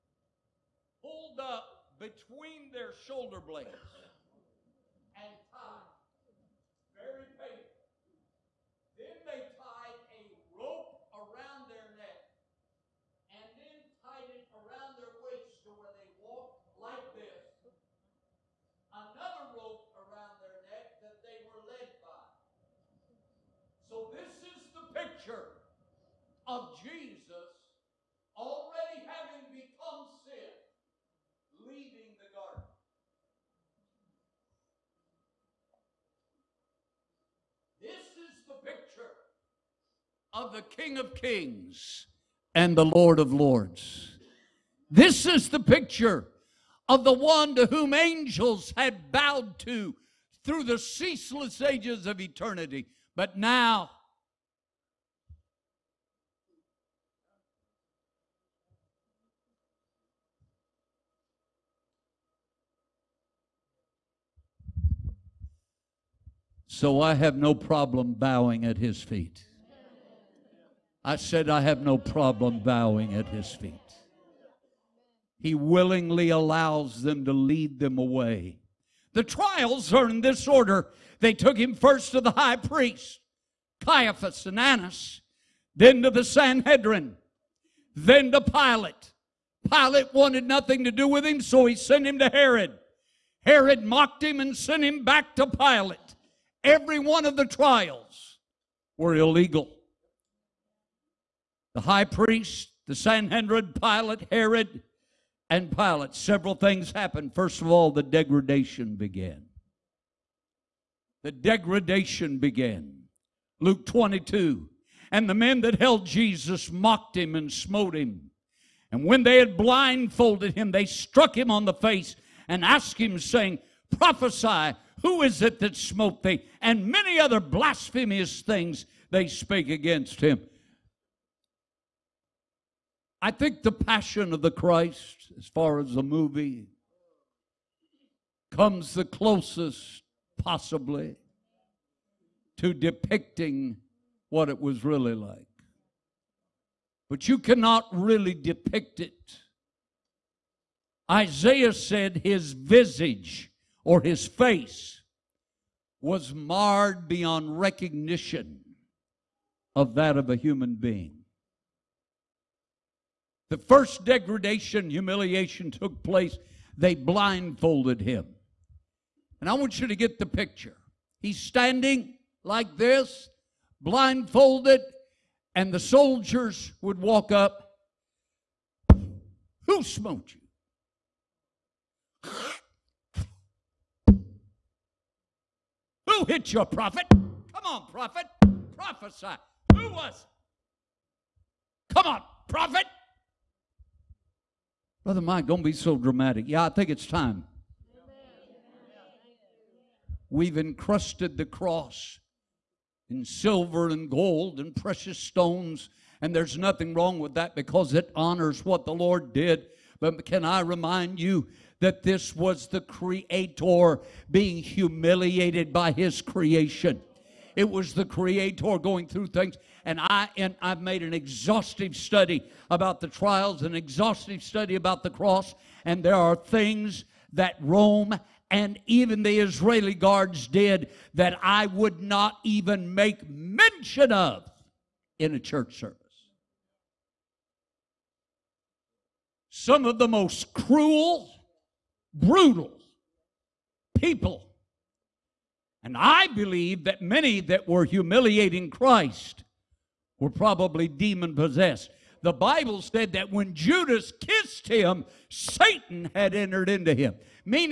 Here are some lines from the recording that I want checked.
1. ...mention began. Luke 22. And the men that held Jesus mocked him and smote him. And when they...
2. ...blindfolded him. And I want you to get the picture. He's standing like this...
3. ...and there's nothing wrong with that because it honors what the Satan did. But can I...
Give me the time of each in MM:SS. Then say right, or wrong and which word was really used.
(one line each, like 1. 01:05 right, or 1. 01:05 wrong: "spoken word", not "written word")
1. 01:51 wrong: "degradation", not "mention"
2. 02:46 right
3. 03:26 wrong: "Lord", not "Satan".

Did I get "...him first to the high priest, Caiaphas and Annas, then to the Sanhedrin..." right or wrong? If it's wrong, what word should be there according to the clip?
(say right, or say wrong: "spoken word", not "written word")
right.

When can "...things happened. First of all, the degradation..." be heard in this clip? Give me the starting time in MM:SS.
01:46.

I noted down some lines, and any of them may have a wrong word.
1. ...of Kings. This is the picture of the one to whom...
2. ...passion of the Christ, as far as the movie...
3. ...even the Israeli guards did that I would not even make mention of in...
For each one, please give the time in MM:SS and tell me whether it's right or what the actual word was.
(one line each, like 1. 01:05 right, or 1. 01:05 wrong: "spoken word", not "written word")
1. 00:43 wrong: "Lords", not "Kings"
2. 02:13 right
3. 03:48 right.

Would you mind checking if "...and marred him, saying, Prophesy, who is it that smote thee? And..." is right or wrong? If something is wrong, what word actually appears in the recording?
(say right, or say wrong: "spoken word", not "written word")
wrong: "asked", not "marred".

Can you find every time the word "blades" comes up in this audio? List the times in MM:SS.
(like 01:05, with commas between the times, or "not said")
00:03.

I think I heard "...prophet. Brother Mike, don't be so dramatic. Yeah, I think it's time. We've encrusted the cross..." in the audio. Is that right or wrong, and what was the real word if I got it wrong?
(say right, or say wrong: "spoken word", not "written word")
right.